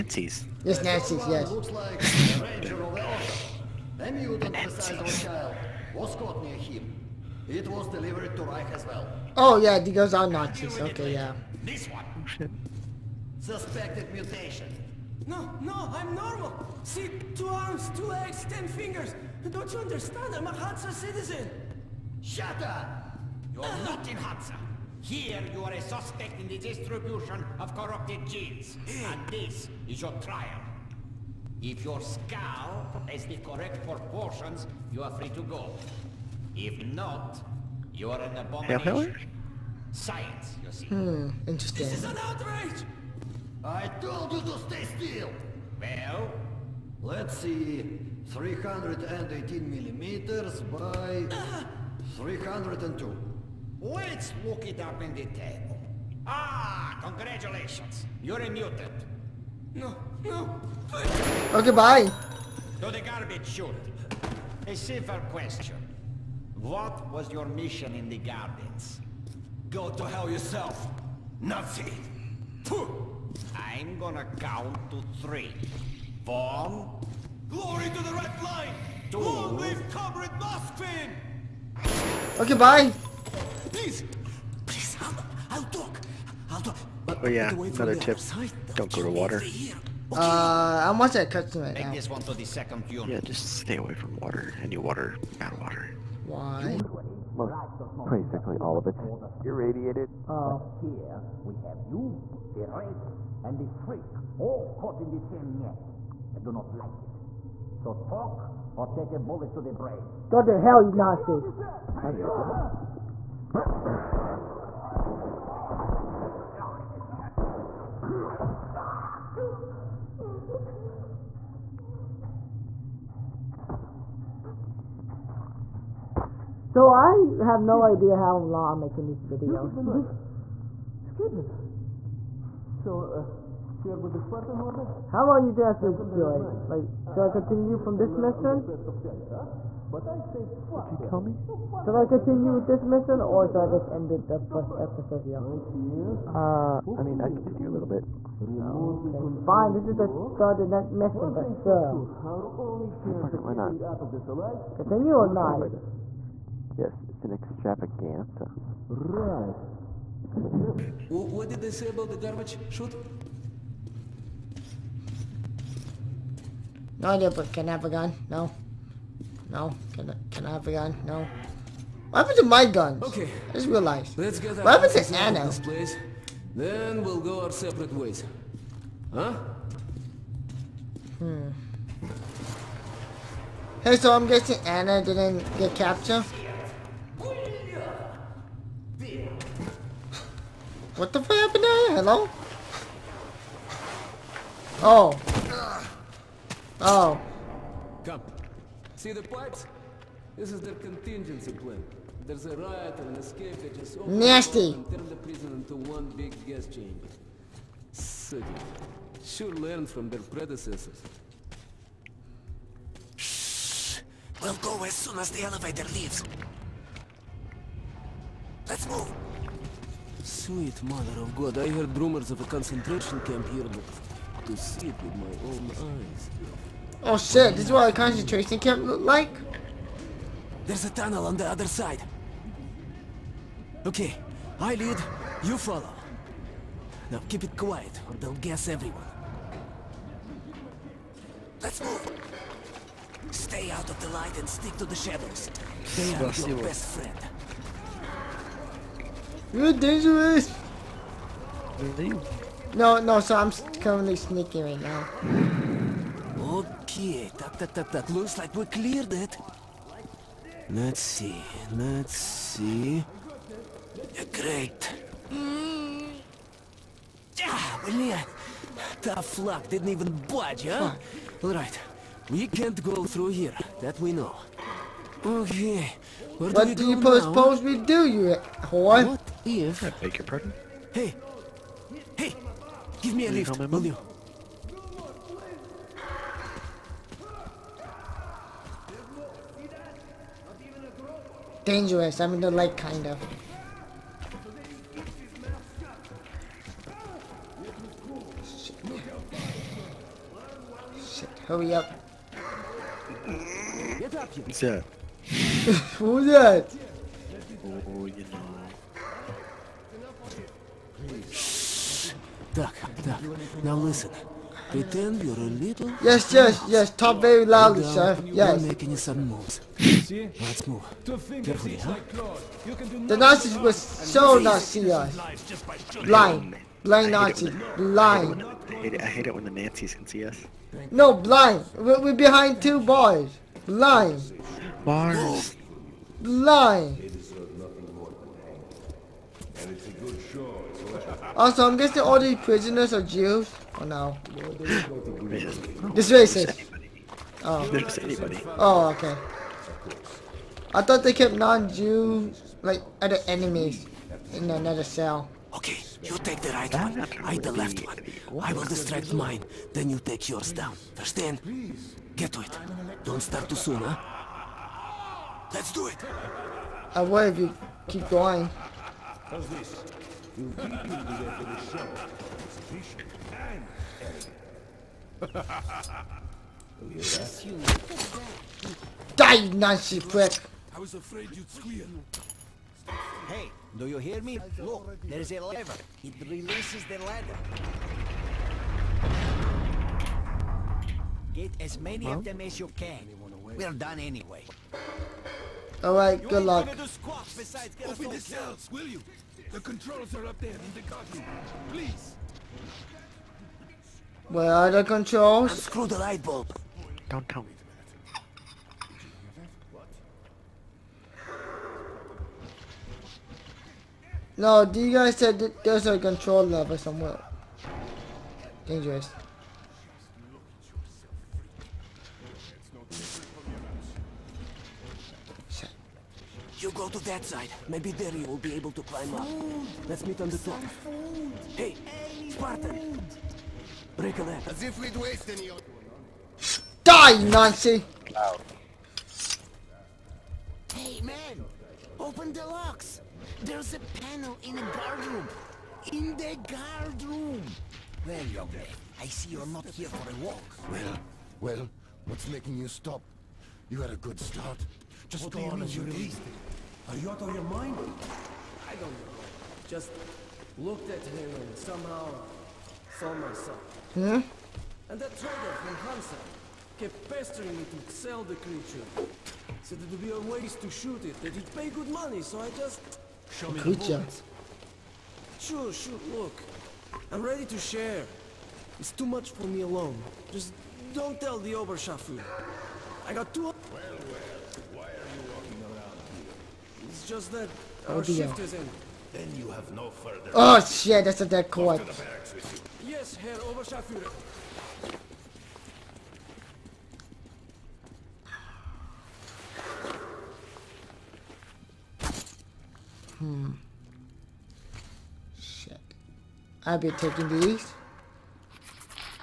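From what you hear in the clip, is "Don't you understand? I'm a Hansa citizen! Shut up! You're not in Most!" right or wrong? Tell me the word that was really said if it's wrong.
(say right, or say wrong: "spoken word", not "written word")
wrong: "Hansa", not "Most".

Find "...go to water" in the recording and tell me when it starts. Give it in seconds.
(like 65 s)
88 s.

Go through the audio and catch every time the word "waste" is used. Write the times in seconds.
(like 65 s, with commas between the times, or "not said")
434 s, 470 s.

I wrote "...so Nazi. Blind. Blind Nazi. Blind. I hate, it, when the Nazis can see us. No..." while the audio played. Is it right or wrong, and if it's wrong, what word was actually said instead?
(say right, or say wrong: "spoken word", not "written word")
right.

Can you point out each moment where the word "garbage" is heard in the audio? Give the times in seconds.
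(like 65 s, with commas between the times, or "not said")
63 s, 162 s.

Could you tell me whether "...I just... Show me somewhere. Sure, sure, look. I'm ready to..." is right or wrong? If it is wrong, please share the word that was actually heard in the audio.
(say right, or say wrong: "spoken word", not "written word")
wrong: "creature", not "somewhere".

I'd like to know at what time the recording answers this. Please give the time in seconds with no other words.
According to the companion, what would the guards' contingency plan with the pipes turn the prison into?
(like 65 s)
206 s.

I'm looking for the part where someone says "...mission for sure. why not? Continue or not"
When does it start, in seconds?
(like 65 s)
150 s.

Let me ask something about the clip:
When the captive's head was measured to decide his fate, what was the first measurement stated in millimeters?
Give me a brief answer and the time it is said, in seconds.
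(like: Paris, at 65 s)
318, at 48 s.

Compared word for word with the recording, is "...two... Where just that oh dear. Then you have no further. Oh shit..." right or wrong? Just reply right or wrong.
right.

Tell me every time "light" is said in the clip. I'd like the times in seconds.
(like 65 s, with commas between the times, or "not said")
244 s, 292 s, 405 s.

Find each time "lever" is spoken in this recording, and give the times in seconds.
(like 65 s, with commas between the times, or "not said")
385 s, 416 s.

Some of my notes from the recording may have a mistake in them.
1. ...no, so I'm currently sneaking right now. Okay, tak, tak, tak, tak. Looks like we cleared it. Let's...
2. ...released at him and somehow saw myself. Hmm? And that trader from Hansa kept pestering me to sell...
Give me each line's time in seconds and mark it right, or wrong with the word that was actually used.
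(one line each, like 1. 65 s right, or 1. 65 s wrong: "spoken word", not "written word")
1. 253 s right
2. 460 s wrong: "looked", not "released".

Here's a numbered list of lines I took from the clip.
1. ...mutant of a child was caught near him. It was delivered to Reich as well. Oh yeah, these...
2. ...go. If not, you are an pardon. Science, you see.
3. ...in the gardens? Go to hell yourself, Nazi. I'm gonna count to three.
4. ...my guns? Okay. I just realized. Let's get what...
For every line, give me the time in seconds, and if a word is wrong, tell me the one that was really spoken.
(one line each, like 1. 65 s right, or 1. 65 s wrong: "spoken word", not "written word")
1. 4 s right
2. 35 s wrong: "abomination", not "pardon"
3. 67 s right
4. 172 s right.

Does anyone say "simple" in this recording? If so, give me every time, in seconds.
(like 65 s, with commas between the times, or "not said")
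64 s.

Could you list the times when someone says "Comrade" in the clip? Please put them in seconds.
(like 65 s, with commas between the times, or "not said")
79 s.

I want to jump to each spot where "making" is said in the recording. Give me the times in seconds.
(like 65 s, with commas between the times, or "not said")
128 s, 318 s, 452 s.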